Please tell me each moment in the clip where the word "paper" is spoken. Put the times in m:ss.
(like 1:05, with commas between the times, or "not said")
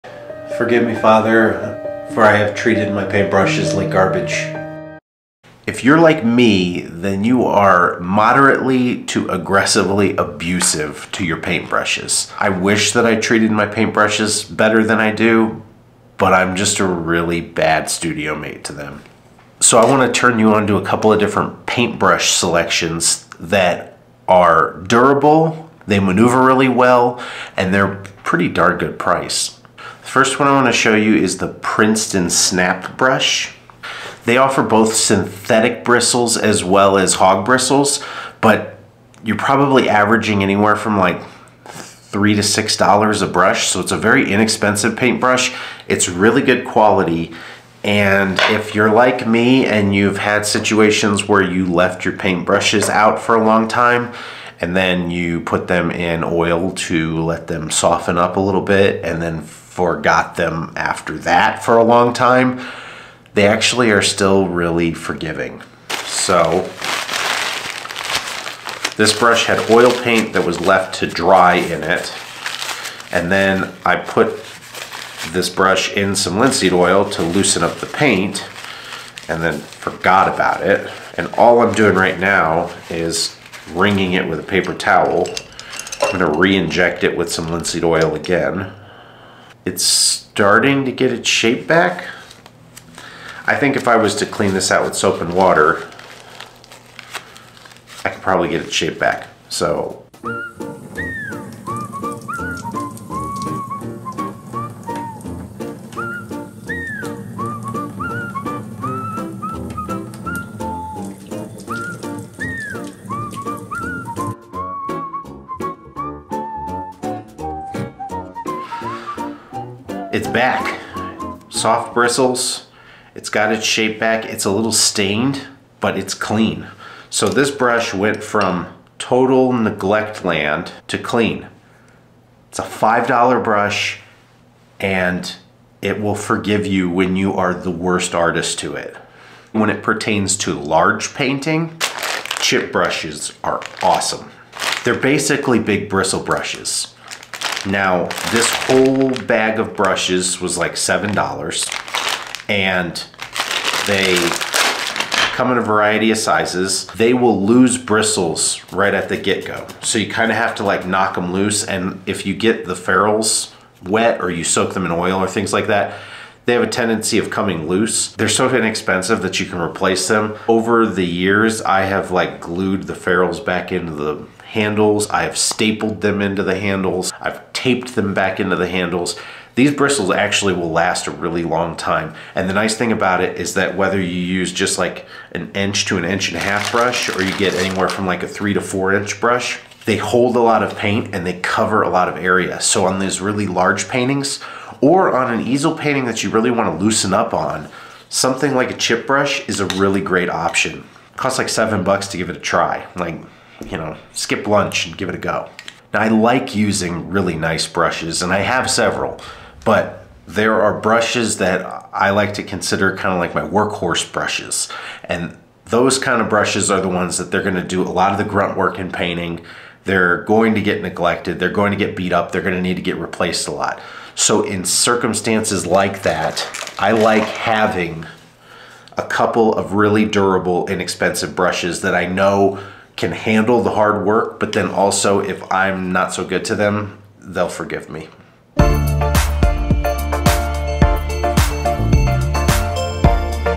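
1:24.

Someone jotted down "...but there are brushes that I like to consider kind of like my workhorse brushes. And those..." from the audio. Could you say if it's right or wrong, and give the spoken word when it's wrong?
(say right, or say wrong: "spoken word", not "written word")
right.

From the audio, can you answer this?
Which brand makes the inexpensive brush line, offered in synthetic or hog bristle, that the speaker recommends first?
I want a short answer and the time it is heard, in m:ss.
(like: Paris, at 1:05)
Princeton, at 0:31.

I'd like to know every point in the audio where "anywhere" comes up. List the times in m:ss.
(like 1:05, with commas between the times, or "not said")
0:40, 3:07.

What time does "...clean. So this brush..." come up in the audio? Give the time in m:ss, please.
2:06.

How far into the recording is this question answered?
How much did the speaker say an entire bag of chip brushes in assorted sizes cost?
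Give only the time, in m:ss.
2:30.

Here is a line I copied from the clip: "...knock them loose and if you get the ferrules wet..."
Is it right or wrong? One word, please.
right.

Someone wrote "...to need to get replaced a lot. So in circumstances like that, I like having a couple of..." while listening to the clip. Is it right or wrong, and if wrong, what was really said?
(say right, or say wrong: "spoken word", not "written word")
right.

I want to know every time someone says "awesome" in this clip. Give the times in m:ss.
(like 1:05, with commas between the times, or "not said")
2:23.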